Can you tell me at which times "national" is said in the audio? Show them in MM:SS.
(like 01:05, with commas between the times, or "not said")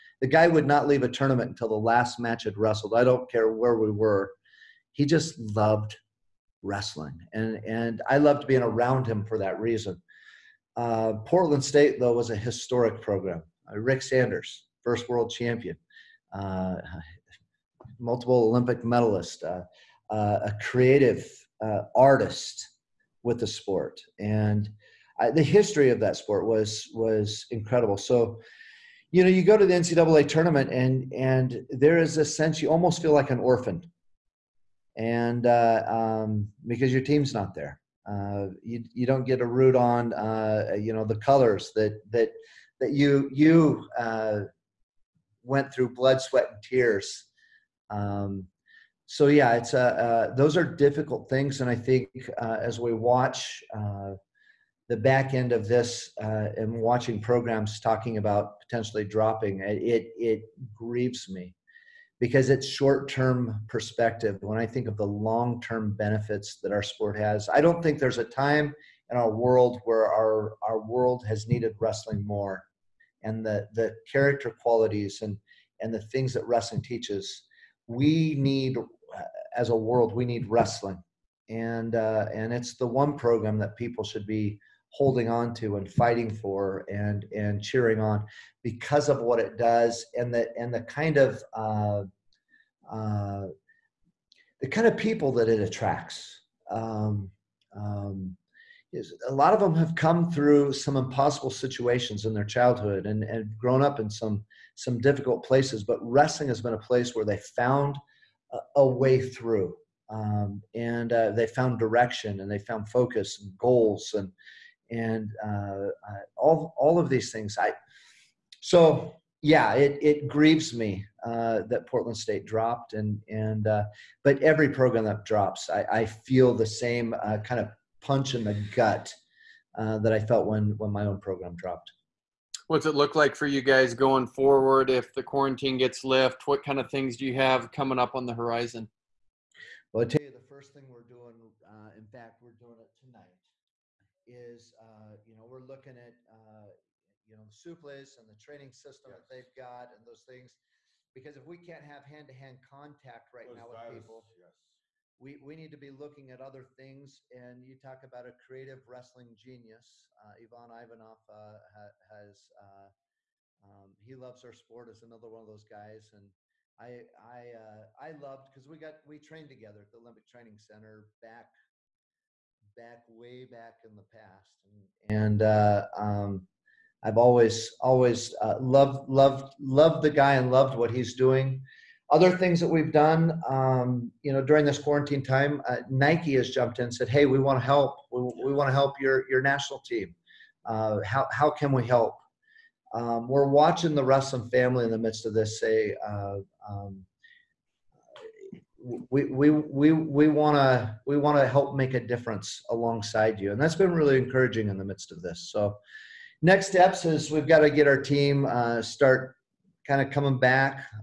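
03:09.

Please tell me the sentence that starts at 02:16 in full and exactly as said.
What kind of things do you have coming up on the horizon?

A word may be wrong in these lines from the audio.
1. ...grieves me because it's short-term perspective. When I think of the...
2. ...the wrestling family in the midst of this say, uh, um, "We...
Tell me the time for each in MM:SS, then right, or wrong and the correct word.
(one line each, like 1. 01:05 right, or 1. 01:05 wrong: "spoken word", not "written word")
1. 01:00 right
2. 03:13 right.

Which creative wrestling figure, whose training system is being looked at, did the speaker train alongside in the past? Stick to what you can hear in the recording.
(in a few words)
Ivan Ivanov.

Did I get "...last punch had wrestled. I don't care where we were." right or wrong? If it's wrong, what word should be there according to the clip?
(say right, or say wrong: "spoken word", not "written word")
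wrong: "match", not "punch".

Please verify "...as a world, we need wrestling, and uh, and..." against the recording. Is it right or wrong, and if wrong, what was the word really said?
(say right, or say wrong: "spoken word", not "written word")
right.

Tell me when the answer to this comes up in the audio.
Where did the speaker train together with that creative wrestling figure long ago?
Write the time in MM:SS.
02:49.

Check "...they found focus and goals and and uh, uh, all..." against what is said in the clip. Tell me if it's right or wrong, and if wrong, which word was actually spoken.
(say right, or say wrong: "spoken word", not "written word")
right.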